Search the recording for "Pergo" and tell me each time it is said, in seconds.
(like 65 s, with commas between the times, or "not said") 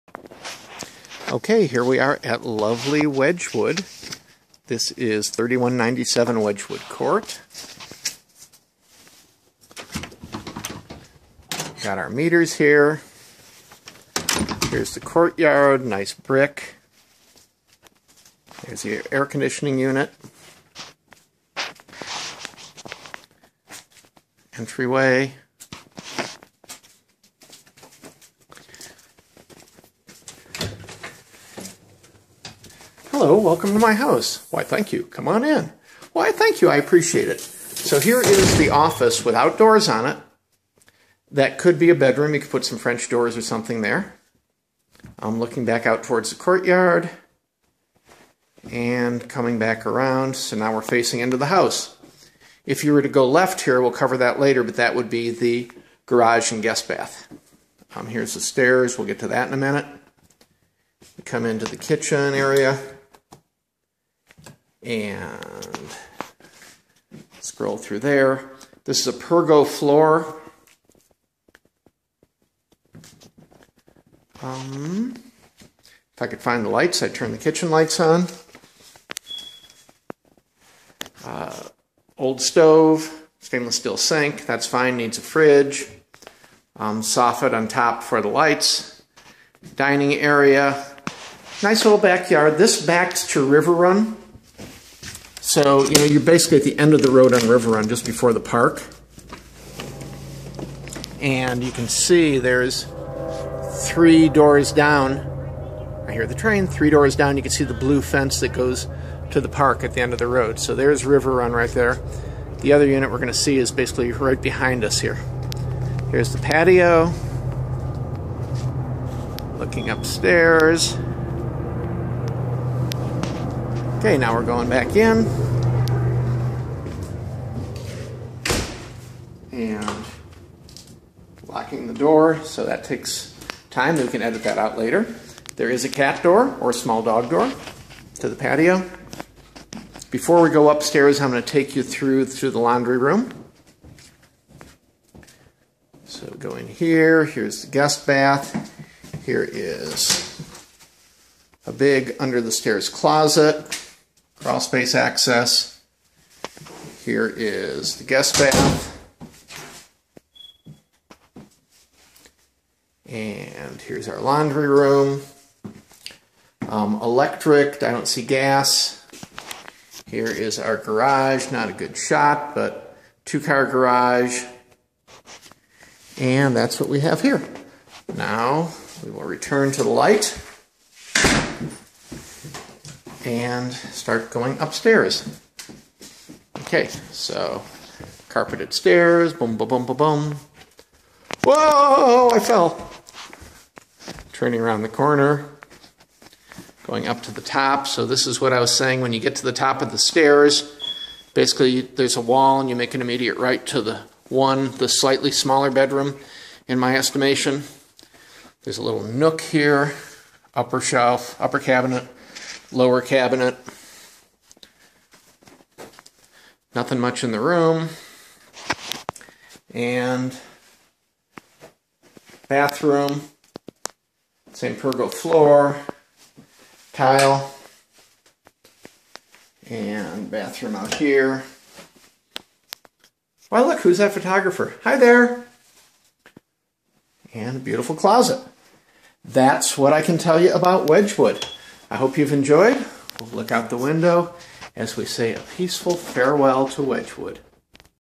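69 s, 224 s.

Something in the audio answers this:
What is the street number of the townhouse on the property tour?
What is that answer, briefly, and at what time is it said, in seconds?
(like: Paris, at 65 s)
3197, at 5 s.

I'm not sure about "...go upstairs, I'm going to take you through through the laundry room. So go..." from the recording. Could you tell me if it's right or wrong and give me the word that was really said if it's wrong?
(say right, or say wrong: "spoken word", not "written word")
right.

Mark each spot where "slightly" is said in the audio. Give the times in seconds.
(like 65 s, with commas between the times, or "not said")
204 s.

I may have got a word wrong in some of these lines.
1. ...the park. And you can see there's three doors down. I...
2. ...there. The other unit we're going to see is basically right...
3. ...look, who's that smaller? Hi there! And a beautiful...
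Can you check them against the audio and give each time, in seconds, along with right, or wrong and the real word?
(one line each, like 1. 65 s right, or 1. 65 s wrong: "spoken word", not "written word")
1. 98 s right
2. 111 s right
3. 233 s wrong: "photographer", not "smaller".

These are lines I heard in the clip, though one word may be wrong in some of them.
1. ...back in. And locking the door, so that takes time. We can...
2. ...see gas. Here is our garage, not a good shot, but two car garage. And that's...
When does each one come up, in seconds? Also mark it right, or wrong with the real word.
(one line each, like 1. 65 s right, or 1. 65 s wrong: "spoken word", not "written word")
1. 124 s right
2. 168 s right.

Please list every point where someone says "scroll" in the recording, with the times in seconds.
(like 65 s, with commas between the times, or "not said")
67 s.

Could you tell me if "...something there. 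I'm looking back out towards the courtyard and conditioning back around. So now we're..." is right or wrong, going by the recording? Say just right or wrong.
wrong.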